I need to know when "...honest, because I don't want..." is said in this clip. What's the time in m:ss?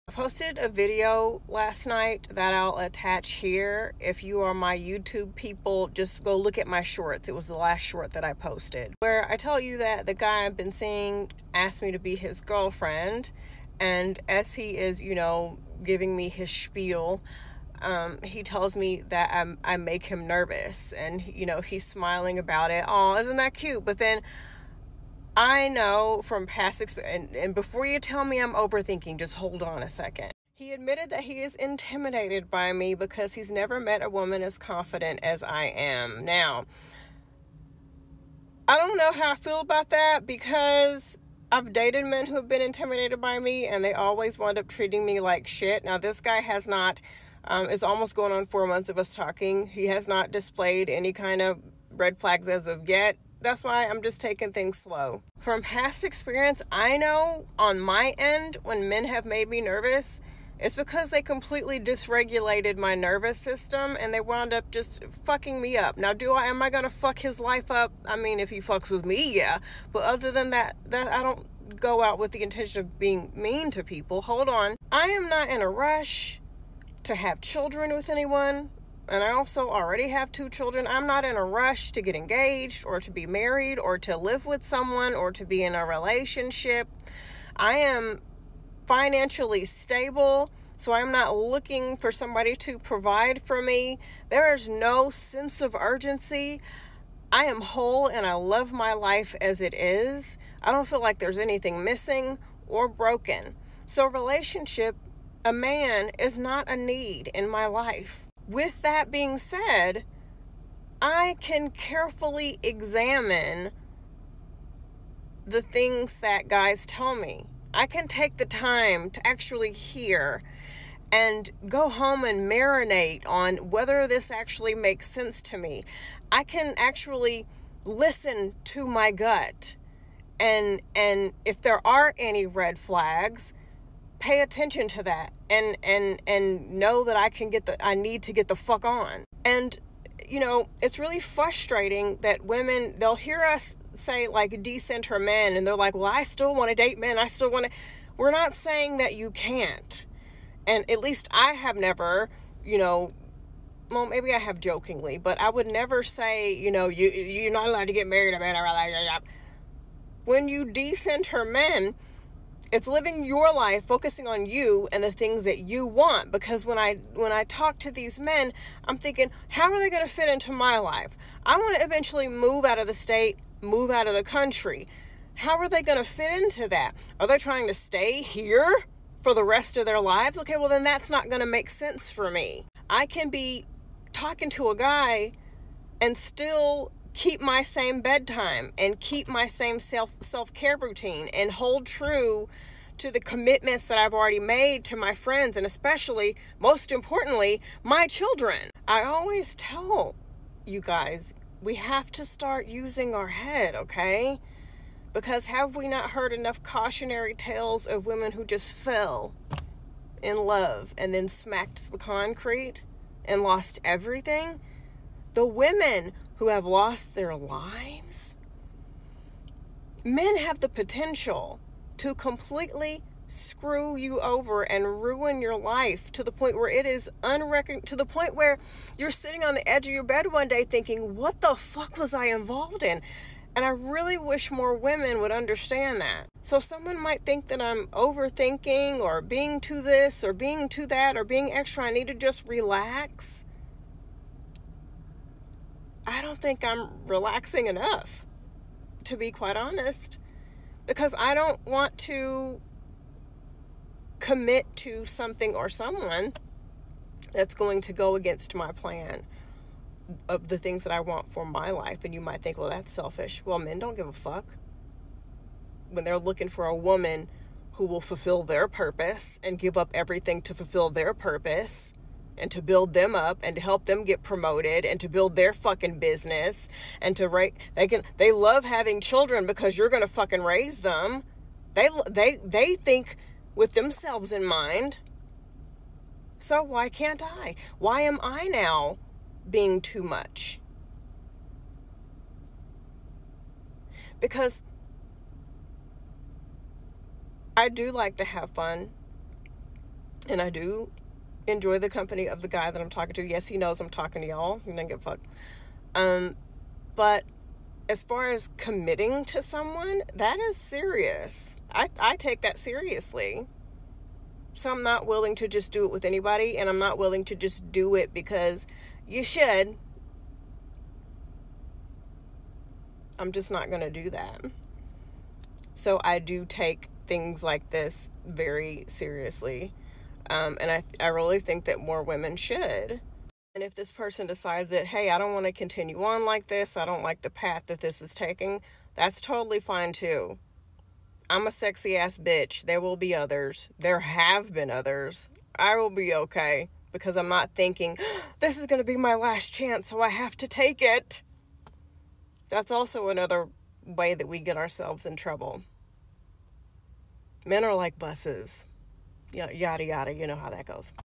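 4:09.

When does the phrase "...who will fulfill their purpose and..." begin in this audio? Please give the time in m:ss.
4:27.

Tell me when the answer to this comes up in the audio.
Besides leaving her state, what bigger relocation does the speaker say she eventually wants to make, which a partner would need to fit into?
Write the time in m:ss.
2:53.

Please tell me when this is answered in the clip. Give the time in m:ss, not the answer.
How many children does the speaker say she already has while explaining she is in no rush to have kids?
1:20.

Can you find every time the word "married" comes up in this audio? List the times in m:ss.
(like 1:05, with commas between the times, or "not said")
1:23, 2:38.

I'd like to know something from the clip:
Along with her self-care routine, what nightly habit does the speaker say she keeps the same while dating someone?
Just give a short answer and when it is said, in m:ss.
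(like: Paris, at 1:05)
bedtime, at 3:08.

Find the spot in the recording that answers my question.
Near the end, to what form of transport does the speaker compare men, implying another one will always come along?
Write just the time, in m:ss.
5:57.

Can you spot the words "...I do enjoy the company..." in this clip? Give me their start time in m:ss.
5:00.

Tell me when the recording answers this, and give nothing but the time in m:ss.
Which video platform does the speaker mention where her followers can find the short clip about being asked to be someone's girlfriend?
0:04.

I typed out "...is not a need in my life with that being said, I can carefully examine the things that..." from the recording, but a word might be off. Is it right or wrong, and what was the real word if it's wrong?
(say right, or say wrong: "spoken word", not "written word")
right.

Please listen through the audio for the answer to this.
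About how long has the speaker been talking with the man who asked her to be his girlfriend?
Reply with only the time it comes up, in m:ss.
0:48.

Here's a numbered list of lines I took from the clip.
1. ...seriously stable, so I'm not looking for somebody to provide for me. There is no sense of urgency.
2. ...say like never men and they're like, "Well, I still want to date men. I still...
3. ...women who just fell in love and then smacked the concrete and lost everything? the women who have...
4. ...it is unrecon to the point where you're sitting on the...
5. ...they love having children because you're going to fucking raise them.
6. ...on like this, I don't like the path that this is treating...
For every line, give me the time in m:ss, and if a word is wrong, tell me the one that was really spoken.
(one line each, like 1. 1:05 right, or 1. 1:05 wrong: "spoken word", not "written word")
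1. 1:28 wrong: "financially", not "seriously"
2. 2:23 wrong: "decenter", not "never"
3. 3:28 right
4. 3:46 right
5. 4:38 right
6. 5:36 wrong: "taking", not "treating".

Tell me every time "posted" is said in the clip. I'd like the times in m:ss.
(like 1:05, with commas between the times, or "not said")
0:00, 0:08.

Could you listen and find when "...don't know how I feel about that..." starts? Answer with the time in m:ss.
0:38.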